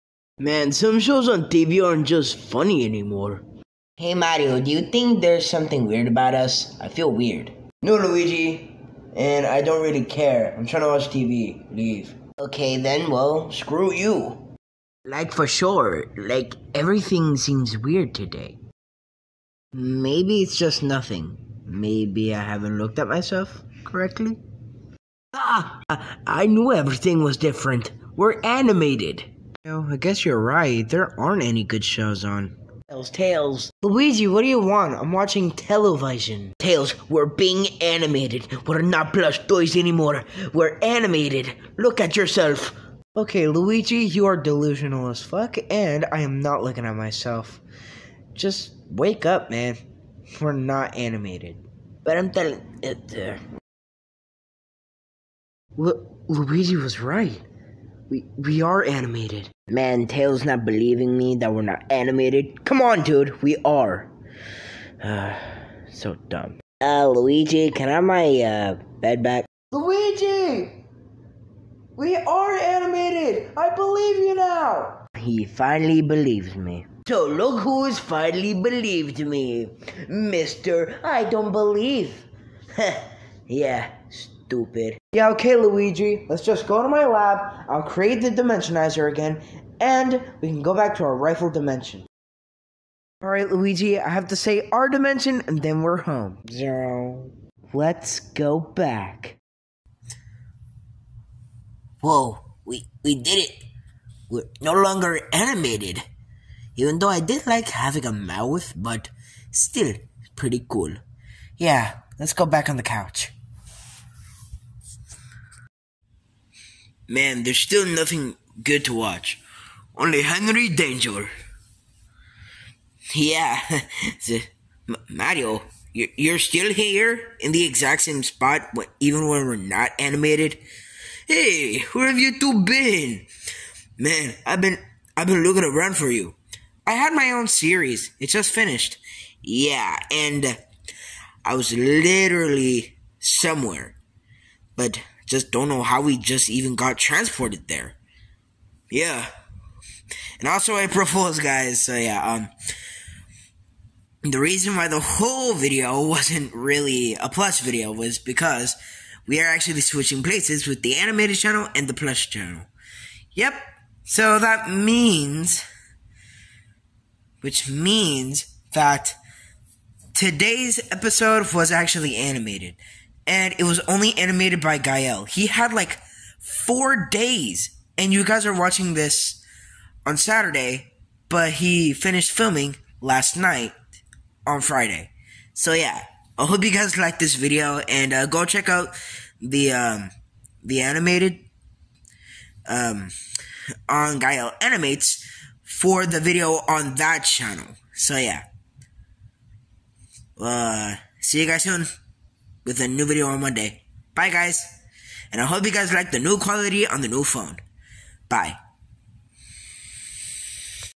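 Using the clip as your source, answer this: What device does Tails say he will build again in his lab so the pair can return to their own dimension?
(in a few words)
The dimensionizer.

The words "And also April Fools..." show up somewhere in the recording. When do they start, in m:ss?
2:30.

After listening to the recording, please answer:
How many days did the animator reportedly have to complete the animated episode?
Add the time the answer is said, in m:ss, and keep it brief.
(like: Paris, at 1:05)
4, at 2:56.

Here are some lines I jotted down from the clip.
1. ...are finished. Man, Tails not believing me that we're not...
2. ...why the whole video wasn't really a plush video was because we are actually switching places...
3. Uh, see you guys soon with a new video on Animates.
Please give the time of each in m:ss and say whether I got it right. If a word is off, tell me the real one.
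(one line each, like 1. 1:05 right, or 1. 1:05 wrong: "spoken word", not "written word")
1. 0:58 wrong: "animated", not "finished"
2. 2:34 right
3. 3:20 wrong: "Monday", not "Animates".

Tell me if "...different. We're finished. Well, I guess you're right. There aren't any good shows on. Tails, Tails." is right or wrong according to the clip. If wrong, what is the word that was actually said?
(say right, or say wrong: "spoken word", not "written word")
wrong: "animated", not "finished".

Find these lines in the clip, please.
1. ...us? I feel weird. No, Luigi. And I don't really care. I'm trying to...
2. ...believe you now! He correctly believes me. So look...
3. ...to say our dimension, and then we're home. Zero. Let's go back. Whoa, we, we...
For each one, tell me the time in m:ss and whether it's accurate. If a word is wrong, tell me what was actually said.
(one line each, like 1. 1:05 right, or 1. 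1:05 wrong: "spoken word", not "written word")
1. 0:06 right
2. 1:13 wrong: "finally", not "correctly"
3. 1:34 right.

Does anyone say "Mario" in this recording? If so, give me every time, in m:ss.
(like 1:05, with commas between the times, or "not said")
0:04, 2:05.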